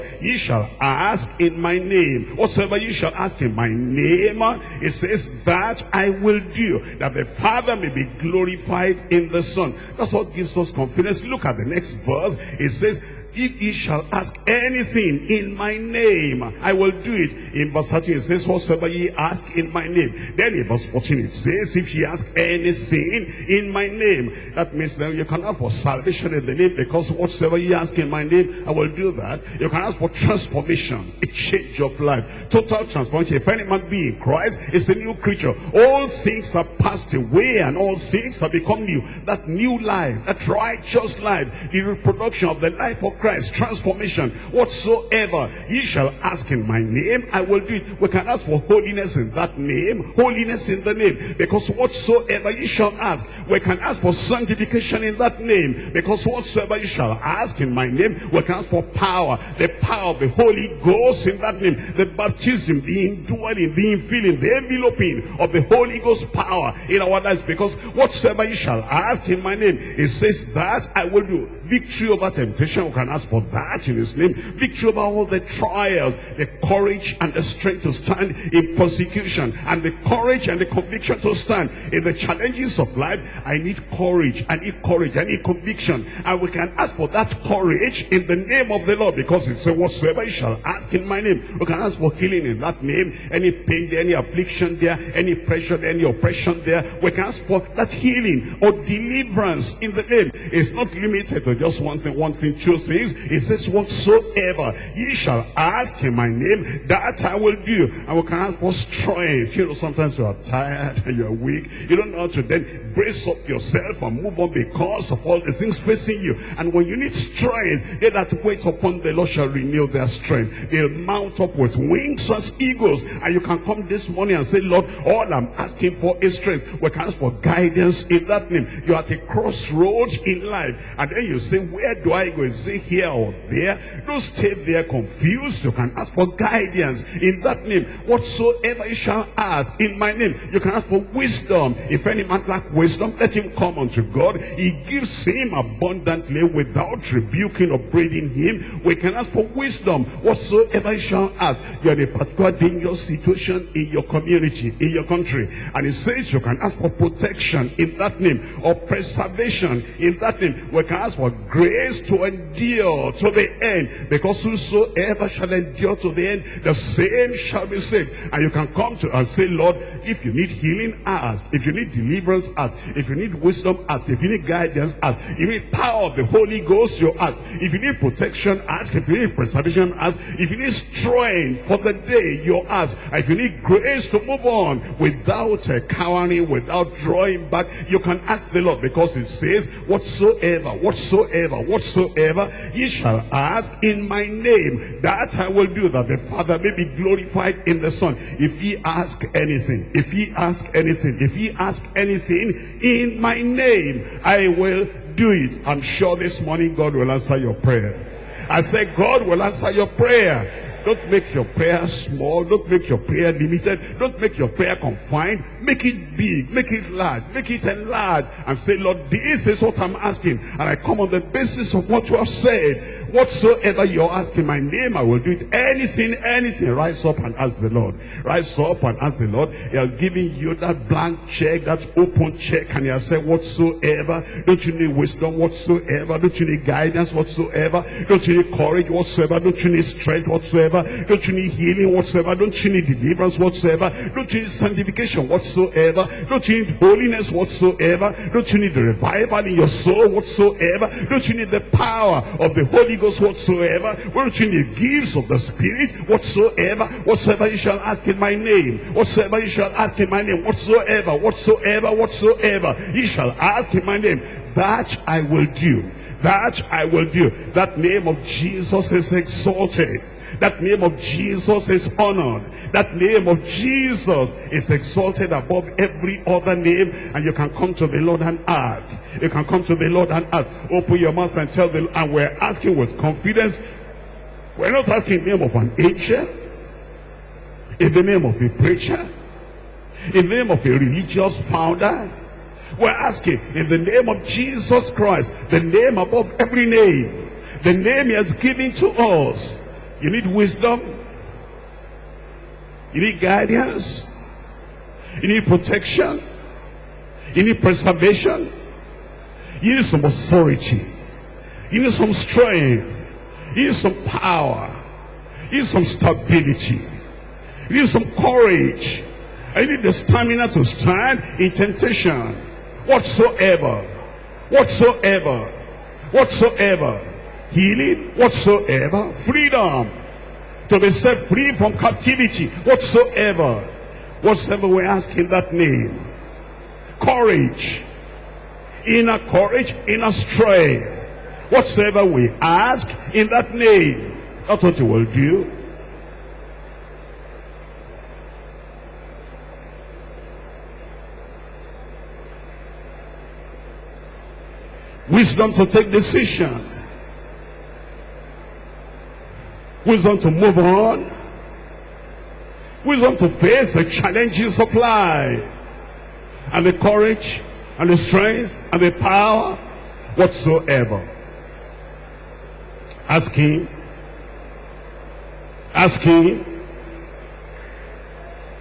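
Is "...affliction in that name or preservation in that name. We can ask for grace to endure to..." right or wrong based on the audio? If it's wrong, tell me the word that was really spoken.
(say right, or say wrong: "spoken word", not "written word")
wrong: "protection", not "affliction".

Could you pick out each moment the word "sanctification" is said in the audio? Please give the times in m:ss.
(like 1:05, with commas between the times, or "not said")
0:54, 4:04.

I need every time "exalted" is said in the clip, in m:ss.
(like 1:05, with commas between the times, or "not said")
4:29, 4:34.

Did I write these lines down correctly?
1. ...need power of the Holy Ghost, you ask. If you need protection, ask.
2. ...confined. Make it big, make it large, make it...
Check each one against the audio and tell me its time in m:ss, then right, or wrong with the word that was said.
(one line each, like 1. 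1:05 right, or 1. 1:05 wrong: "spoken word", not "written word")
1. 2:55 right
2. 3:34 right.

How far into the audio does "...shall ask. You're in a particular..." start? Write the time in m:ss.
2:30.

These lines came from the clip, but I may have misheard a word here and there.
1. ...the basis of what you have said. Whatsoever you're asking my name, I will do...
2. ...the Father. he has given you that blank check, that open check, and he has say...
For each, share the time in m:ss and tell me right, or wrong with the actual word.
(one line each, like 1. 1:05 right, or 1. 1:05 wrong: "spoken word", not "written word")
1. 3:41 right
2. 3:49 wrong: "Lord", not "Father".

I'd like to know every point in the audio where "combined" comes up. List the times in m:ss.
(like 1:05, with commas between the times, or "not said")
not said.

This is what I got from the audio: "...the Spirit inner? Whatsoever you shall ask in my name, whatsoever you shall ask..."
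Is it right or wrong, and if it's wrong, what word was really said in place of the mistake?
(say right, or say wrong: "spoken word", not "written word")
wrong: "whatsoever", not "inner".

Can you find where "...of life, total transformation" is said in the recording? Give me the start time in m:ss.
0:31.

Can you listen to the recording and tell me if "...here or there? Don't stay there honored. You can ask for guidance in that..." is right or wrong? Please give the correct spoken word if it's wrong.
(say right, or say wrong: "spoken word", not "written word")
wrong: "confused", not "honored".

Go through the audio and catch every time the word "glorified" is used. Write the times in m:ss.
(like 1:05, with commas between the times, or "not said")
0:08, 3:16.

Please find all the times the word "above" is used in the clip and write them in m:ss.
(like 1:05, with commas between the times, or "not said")
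4:35, 4:55.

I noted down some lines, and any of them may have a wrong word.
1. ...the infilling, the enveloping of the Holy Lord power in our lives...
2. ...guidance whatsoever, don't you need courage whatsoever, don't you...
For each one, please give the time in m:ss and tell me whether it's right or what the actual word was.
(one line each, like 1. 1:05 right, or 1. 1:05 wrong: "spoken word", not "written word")
1. 1:03 wrong: "Ghost", not "Lord"
2. 3:56 right.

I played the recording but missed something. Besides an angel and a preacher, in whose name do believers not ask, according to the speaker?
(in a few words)
A religious founder.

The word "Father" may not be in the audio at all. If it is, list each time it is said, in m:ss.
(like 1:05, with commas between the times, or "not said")
0:07, 3:16.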